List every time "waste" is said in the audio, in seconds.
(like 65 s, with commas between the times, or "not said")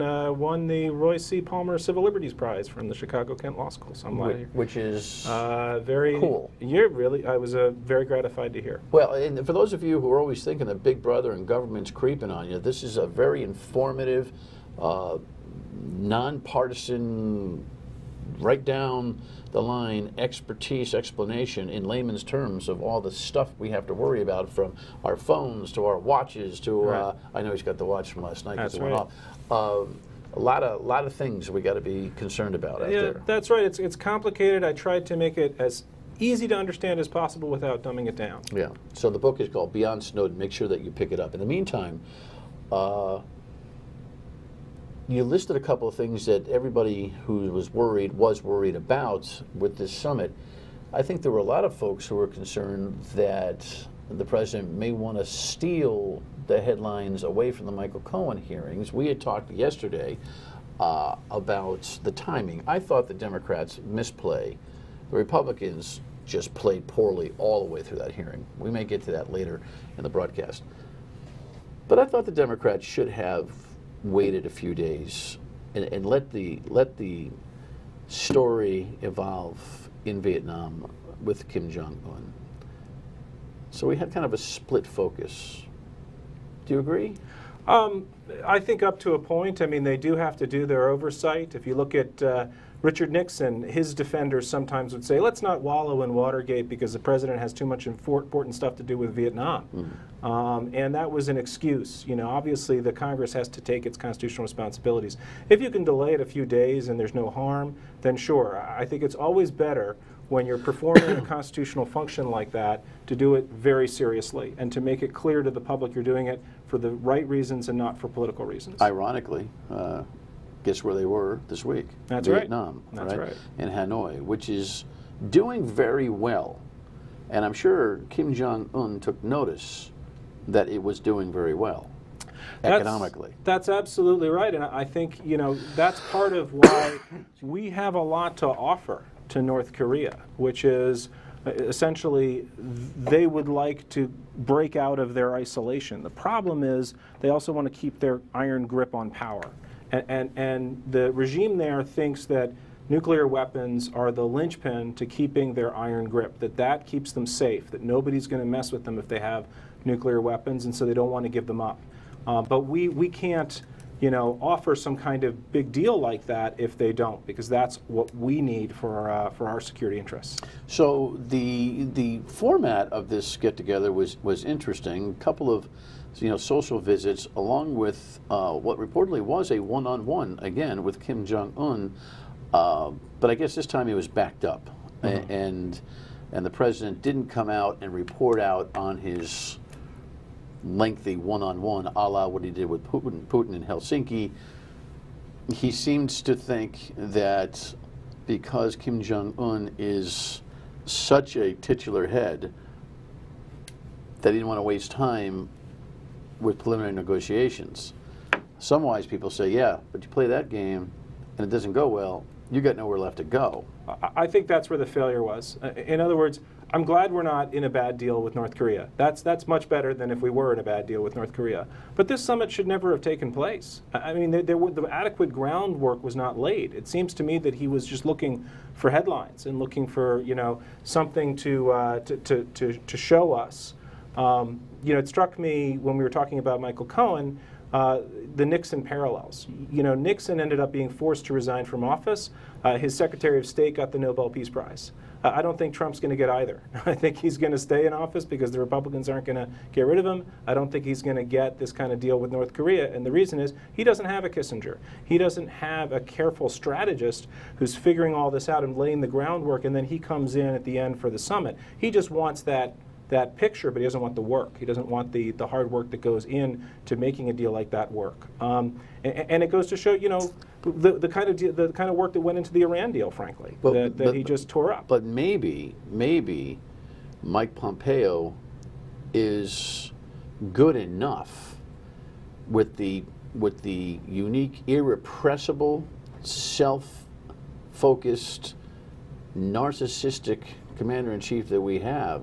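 204 s.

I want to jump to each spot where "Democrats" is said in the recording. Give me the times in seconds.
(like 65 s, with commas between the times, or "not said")
63 s, 72 s.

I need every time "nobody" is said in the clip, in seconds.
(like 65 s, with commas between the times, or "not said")
157 s.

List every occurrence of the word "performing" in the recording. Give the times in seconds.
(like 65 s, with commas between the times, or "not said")
110 s.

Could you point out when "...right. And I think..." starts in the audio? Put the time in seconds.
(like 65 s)
134 s.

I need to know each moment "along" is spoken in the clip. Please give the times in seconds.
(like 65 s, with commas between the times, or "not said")
177 s.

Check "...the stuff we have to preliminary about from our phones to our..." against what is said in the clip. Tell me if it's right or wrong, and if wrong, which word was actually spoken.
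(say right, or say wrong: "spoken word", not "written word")
wrong: "worry", not "preliminary".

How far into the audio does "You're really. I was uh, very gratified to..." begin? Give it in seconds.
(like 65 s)
6 s.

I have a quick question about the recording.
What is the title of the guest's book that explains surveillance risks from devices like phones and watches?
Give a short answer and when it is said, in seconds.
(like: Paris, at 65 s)
Beyond Snowden, at 39 s.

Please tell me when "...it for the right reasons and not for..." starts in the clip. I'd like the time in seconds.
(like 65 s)
116 s.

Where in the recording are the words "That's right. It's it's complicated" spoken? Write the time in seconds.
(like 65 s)
33 s.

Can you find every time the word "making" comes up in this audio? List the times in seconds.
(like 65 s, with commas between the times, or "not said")
266 s.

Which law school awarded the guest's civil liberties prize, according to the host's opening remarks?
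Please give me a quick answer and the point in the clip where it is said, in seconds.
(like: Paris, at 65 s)
Chicago Kent Law School, at 2 s.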